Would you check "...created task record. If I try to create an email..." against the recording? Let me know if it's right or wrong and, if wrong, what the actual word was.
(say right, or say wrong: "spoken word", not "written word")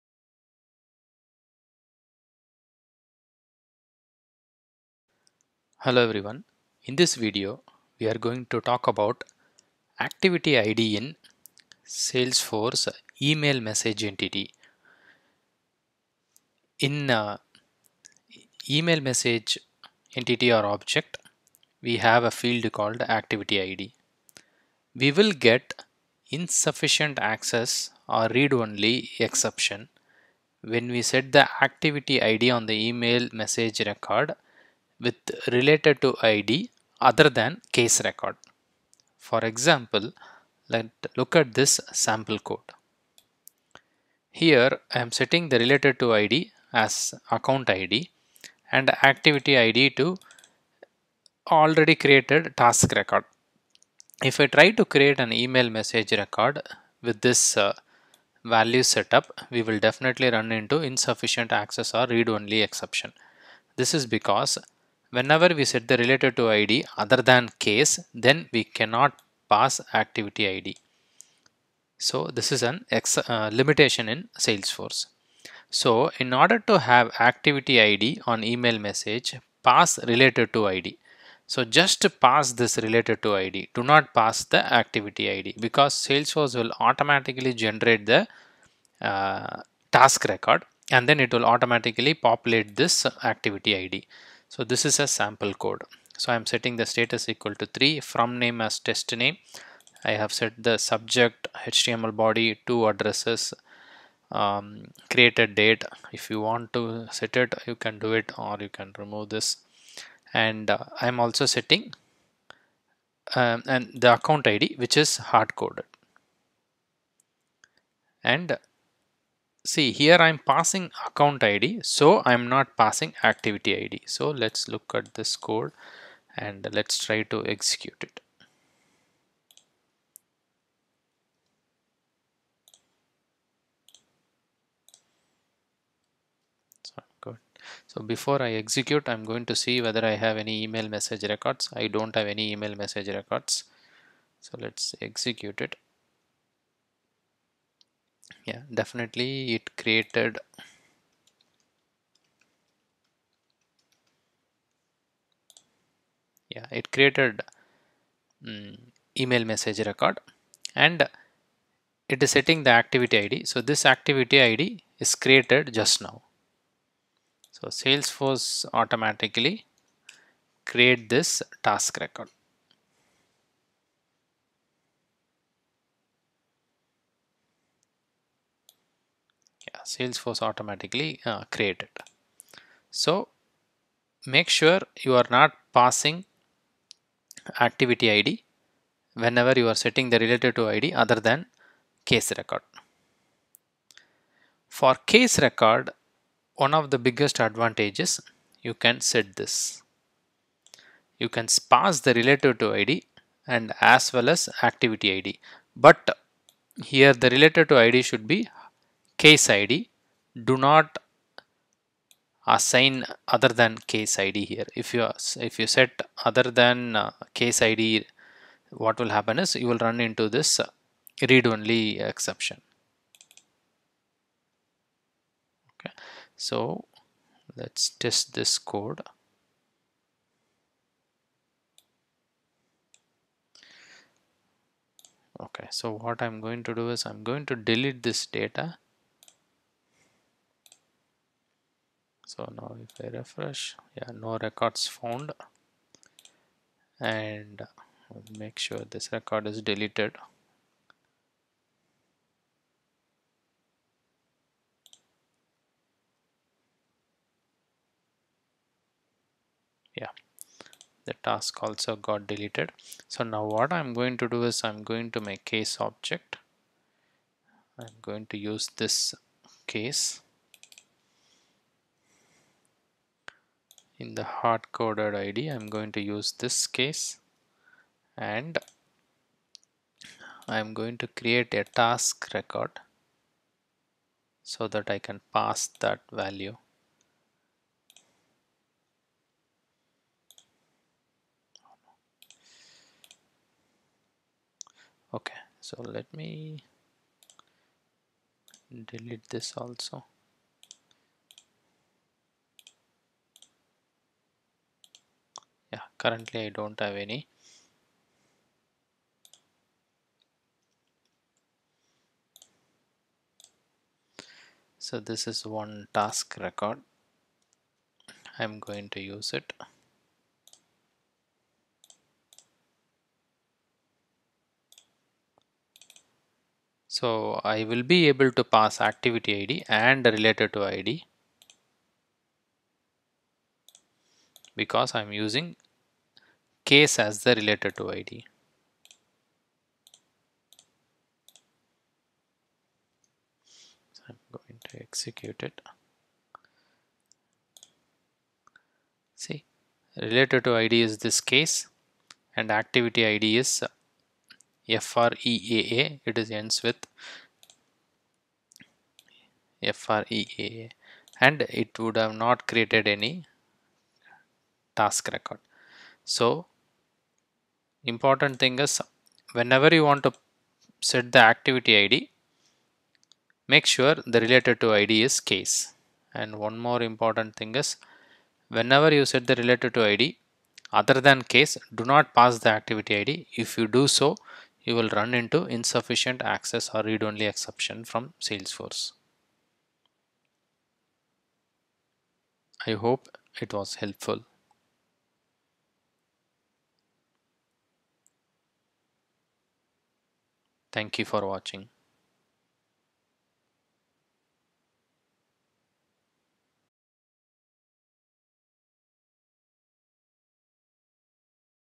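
right.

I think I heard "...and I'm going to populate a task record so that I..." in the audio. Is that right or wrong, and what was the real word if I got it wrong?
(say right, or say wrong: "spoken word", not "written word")
wrong: "create", not "populate".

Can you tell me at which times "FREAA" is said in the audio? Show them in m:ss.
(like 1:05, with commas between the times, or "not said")
5:54, 5:59.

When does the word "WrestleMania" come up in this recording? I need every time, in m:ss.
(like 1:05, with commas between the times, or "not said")
not said.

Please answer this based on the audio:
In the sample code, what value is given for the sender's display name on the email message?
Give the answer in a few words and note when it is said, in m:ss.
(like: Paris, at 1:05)
test name, at 1:38.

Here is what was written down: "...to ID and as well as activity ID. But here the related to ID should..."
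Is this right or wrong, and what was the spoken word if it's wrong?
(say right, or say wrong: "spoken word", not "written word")
right.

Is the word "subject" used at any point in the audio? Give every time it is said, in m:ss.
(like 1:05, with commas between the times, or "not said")
1:40.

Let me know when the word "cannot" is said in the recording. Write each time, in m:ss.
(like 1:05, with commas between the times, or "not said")
1:08.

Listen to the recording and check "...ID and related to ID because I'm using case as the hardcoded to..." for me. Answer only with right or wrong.
wrong.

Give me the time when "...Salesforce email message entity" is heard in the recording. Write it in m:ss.
0:11.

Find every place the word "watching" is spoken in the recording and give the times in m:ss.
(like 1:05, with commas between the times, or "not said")
6:41.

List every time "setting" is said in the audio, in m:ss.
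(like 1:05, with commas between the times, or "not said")
0:45, 1:36, 1:51, 2:42, 3:09.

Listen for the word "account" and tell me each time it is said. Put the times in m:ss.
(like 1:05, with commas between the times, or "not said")
0:47, 1:54, 2:01.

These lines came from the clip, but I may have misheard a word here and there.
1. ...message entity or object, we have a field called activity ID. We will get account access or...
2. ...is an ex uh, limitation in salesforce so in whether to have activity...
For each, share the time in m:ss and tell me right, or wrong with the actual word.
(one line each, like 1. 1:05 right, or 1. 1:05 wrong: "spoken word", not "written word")
1. 0:19 wrong: "insufficient", not "account"
2. 1:12 wrong: "order", not "whether".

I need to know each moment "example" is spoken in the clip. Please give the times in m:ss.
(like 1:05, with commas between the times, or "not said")
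0:39.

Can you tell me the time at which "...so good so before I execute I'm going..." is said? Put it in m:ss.
2:16.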